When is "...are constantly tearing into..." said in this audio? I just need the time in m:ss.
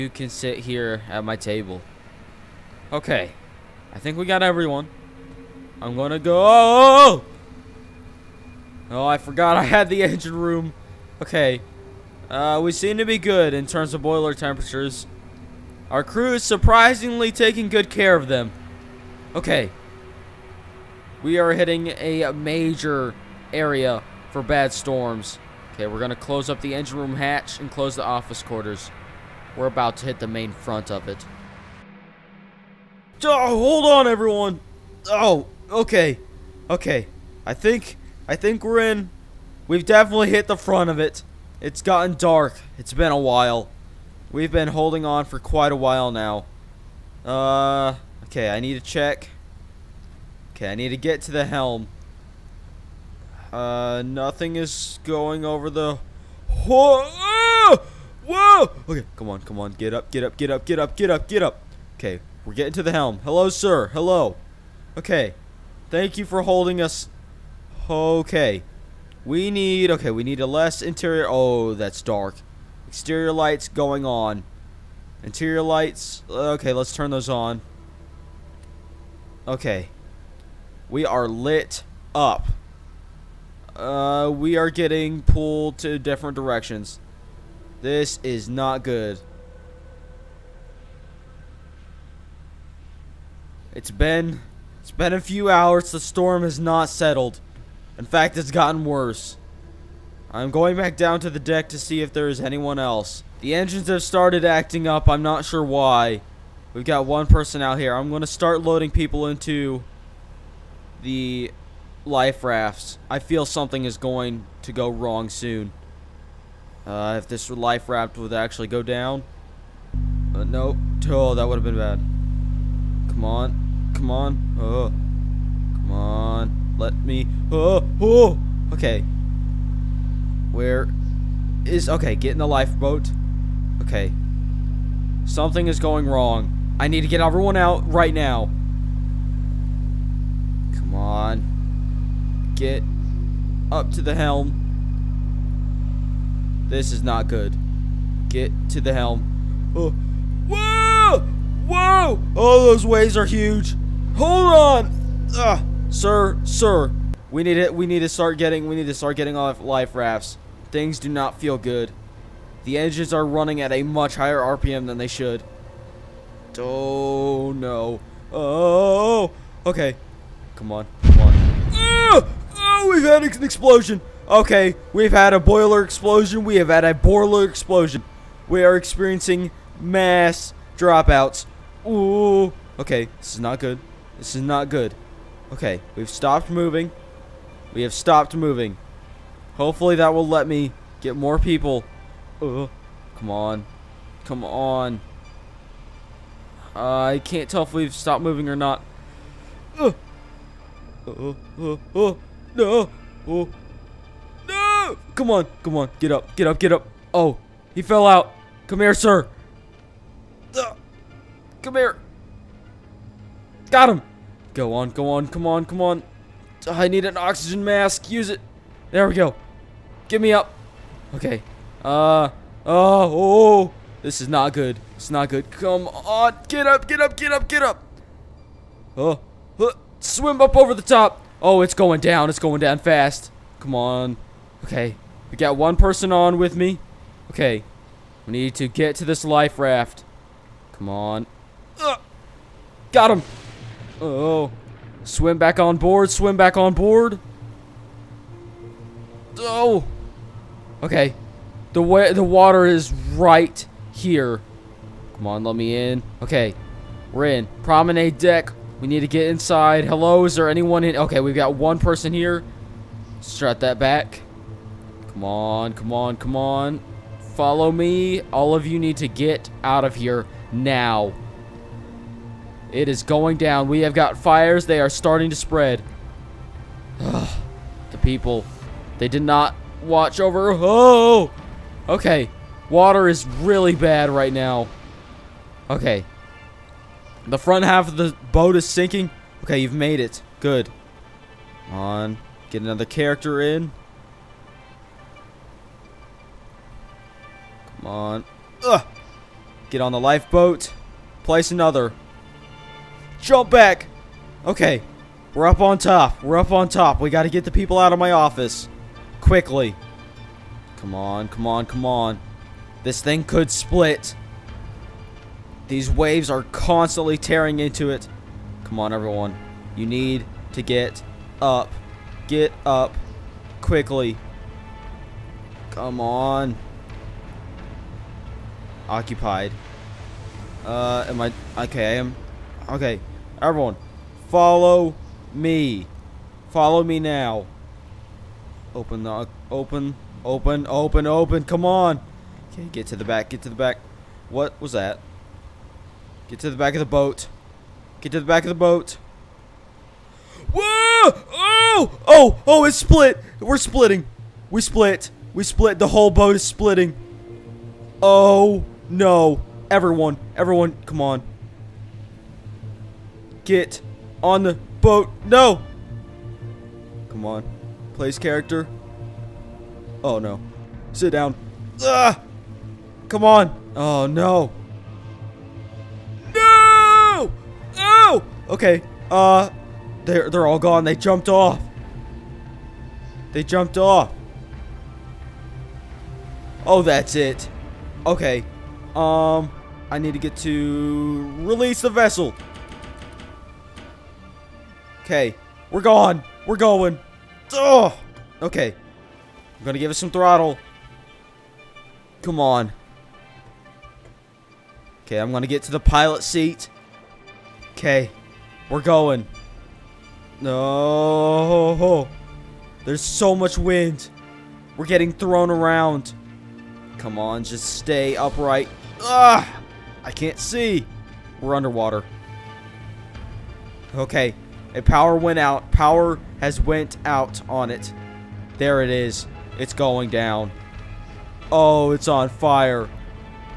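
5:16.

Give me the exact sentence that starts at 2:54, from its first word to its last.
Okay, we've had a boiler explosion.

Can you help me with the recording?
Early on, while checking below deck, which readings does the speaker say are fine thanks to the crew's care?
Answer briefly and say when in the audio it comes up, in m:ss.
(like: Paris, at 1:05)
Boiler temperatures, at 0:14.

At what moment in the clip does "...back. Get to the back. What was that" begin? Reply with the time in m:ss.
5:43.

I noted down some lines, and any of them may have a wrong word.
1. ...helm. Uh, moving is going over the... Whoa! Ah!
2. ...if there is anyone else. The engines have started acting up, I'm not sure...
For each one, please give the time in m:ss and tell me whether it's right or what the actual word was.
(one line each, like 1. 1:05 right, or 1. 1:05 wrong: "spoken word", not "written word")
1. 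0:51 wrong: "nothing", not "moving"
2. 1:42 right.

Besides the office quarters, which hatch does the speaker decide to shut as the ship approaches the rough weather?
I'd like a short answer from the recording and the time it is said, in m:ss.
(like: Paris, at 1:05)
Engine room hatch, at 0:26.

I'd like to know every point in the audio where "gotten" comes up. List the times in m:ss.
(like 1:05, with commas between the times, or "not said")
0:41, 1:38.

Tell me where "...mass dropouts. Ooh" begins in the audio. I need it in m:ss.
2:59.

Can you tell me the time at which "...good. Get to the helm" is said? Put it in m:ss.
2:27.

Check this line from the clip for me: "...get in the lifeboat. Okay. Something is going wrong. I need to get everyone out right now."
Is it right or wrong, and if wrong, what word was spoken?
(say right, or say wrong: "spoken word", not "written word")
right.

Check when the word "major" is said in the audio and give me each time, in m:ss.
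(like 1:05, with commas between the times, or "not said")
0:22.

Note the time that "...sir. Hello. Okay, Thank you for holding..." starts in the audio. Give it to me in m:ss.
1:03.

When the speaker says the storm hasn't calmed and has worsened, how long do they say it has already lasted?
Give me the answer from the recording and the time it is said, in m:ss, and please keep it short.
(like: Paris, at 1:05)
A few hours, at 1:35.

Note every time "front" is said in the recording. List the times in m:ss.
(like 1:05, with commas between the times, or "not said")
0:30, 0:40, 4:47.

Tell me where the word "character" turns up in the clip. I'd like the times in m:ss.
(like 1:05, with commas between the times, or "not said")
4:52, 6:08.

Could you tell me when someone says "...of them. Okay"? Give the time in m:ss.
0:18.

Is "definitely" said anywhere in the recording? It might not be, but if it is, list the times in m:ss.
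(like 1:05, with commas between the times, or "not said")
0:39.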